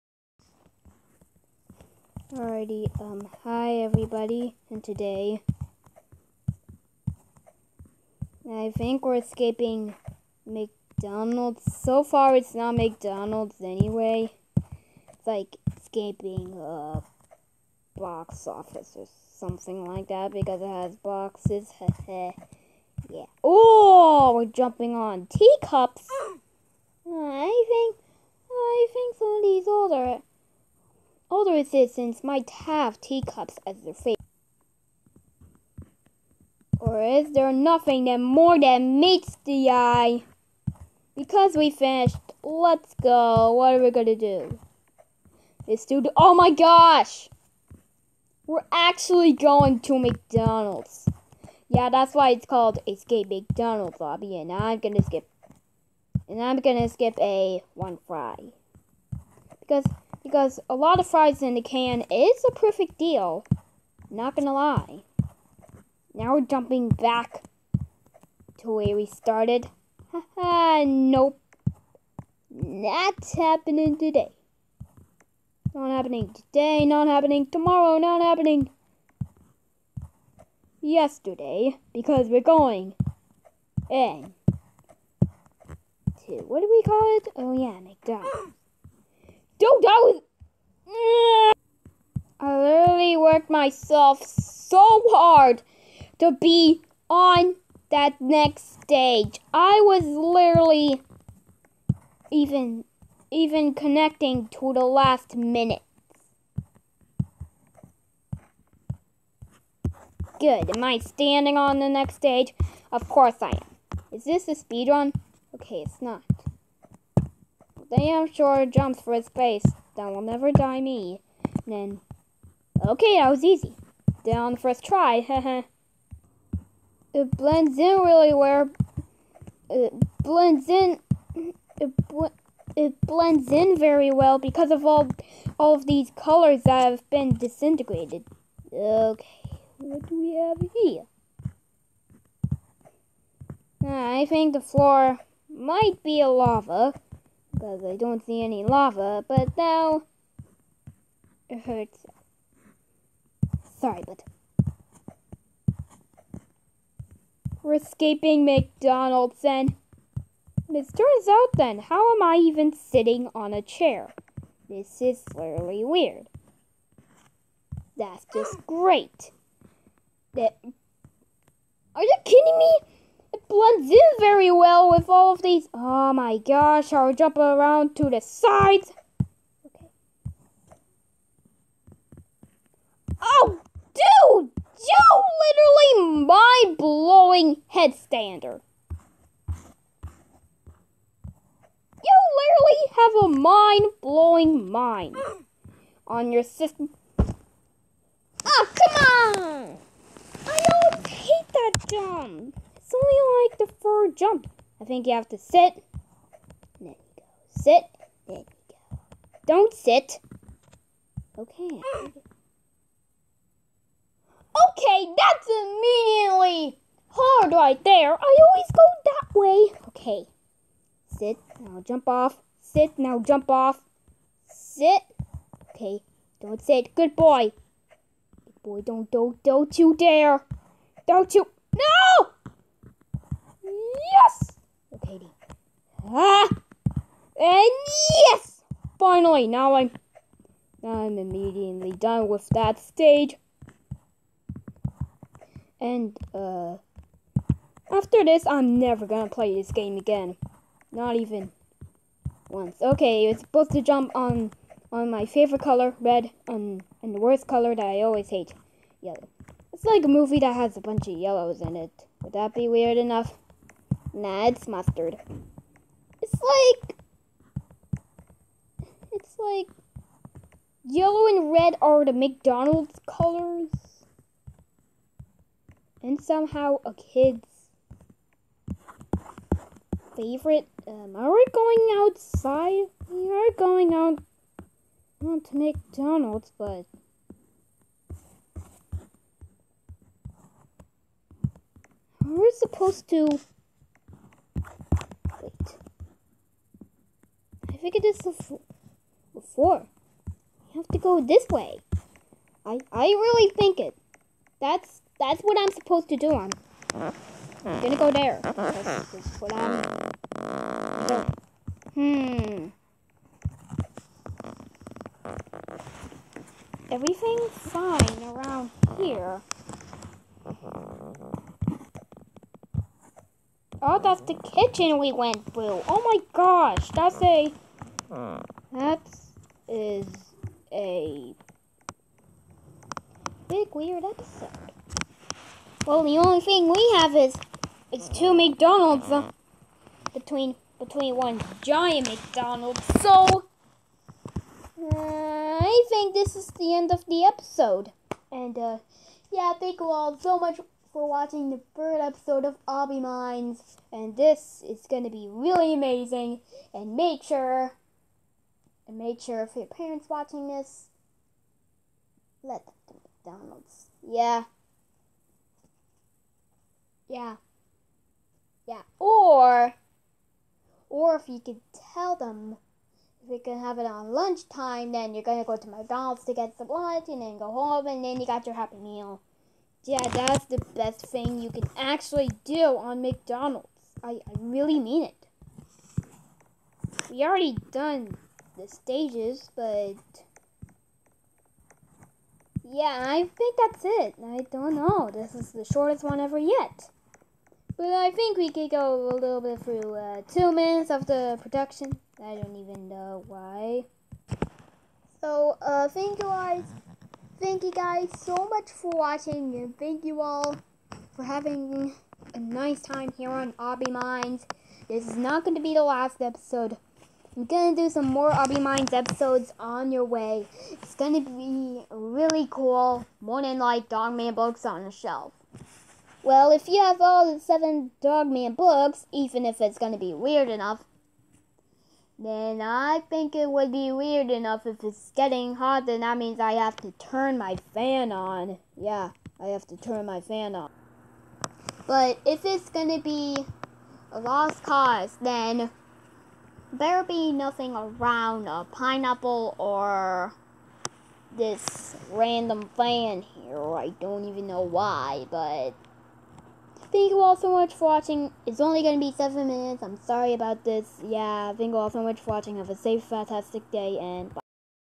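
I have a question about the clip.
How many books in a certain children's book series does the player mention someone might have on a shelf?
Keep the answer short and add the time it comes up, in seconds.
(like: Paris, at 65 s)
7, at 427 s.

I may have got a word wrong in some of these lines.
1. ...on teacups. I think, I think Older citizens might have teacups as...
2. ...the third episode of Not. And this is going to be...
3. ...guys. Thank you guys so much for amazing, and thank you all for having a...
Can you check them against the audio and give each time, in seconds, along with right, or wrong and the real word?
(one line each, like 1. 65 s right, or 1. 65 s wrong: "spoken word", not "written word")
1. 24 s right
2. 351 s wrong: "Obbymines", not "Not"
3. 406 s wrong: "watching", not "amazing".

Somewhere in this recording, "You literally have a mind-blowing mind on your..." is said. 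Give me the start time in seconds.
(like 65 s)
192 s.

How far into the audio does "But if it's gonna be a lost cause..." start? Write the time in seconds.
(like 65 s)
441 s.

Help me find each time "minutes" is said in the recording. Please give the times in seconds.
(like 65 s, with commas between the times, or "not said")
105 s, 400 s, 459 s.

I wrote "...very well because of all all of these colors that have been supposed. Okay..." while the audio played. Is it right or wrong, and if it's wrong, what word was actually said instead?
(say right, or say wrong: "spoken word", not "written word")
wrong: "disintegrated", not "supposed".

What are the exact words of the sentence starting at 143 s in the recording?
I think the floor might be a lava because I don't see any lava, but now it hurts.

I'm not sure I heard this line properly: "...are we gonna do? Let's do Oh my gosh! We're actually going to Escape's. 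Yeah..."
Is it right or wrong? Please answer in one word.
wrong.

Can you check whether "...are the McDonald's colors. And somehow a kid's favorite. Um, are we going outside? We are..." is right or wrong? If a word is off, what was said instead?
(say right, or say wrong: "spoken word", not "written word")
right.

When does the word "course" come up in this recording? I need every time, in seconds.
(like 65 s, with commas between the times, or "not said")
113 s.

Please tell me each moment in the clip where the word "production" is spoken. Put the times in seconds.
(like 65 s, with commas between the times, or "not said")
401 s.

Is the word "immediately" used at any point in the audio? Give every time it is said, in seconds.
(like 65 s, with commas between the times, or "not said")
215 s, 241 s.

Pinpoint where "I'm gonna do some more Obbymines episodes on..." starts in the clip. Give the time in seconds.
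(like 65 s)
417 s.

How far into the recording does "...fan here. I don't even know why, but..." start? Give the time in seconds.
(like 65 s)
452 s.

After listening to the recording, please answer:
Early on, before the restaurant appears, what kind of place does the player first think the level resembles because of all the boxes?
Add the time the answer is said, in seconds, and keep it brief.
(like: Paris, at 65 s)
box office, at 17 s.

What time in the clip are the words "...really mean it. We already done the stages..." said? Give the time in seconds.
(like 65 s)
384 s.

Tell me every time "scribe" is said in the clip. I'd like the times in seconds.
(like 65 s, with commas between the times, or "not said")
not said.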